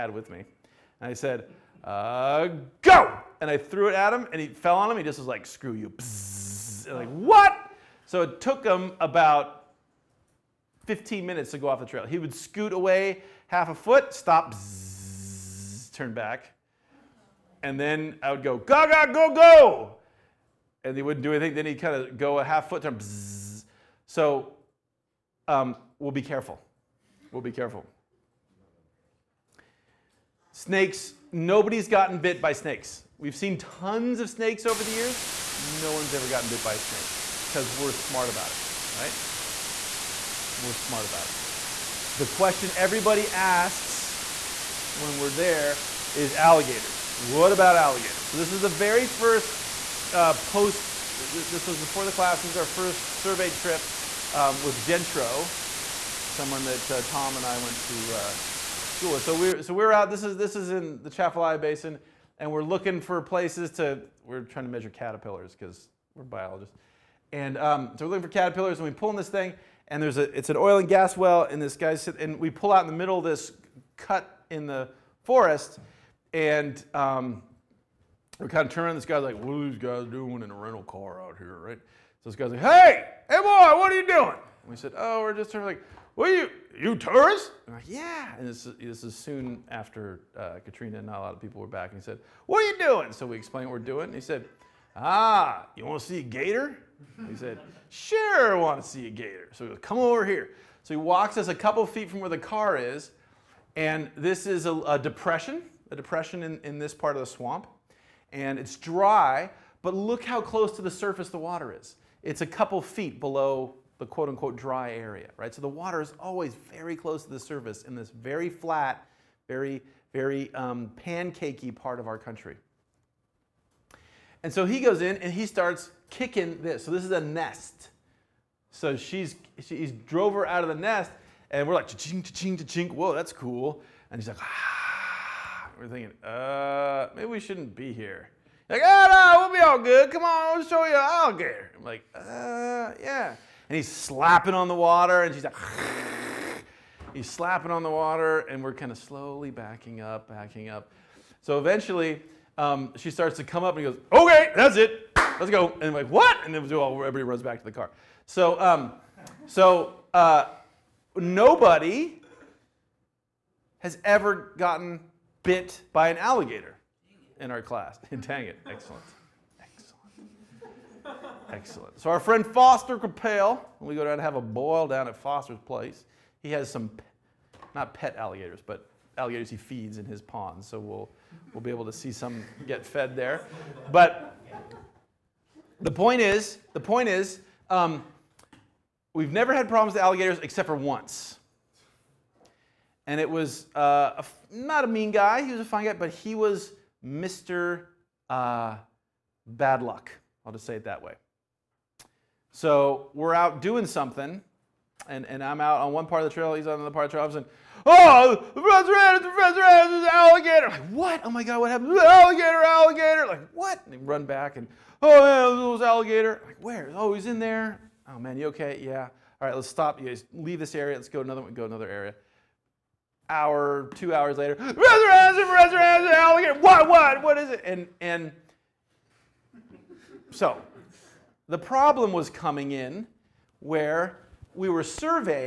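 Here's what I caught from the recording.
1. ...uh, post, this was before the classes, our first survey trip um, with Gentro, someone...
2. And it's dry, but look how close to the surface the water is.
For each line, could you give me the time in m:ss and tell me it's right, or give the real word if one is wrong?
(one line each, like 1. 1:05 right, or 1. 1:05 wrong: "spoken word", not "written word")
1. 0:50 right
2. 1:48 right.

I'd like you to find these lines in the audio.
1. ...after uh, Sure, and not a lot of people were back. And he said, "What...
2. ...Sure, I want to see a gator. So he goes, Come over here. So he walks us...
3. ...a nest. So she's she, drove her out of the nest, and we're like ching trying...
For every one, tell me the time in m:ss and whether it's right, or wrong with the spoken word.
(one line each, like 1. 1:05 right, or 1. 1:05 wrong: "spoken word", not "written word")
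1. 1:29 wrong: "Katrina", not "Sure"
2. 1:37 right
3. 2:07 wrong: "ching", not "trying".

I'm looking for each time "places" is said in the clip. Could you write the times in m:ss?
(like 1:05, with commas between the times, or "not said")
1:03, 2:55.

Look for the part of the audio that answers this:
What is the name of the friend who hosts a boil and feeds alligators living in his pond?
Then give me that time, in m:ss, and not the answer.
2:52.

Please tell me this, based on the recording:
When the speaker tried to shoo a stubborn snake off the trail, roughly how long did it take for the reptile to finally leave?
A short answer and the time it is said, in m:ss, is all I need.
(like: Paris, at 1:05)
15 minutes, at 0:10.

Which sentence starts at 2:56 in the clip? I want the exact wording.
He has some, not pet alligators, but alligators he feeds in his pond.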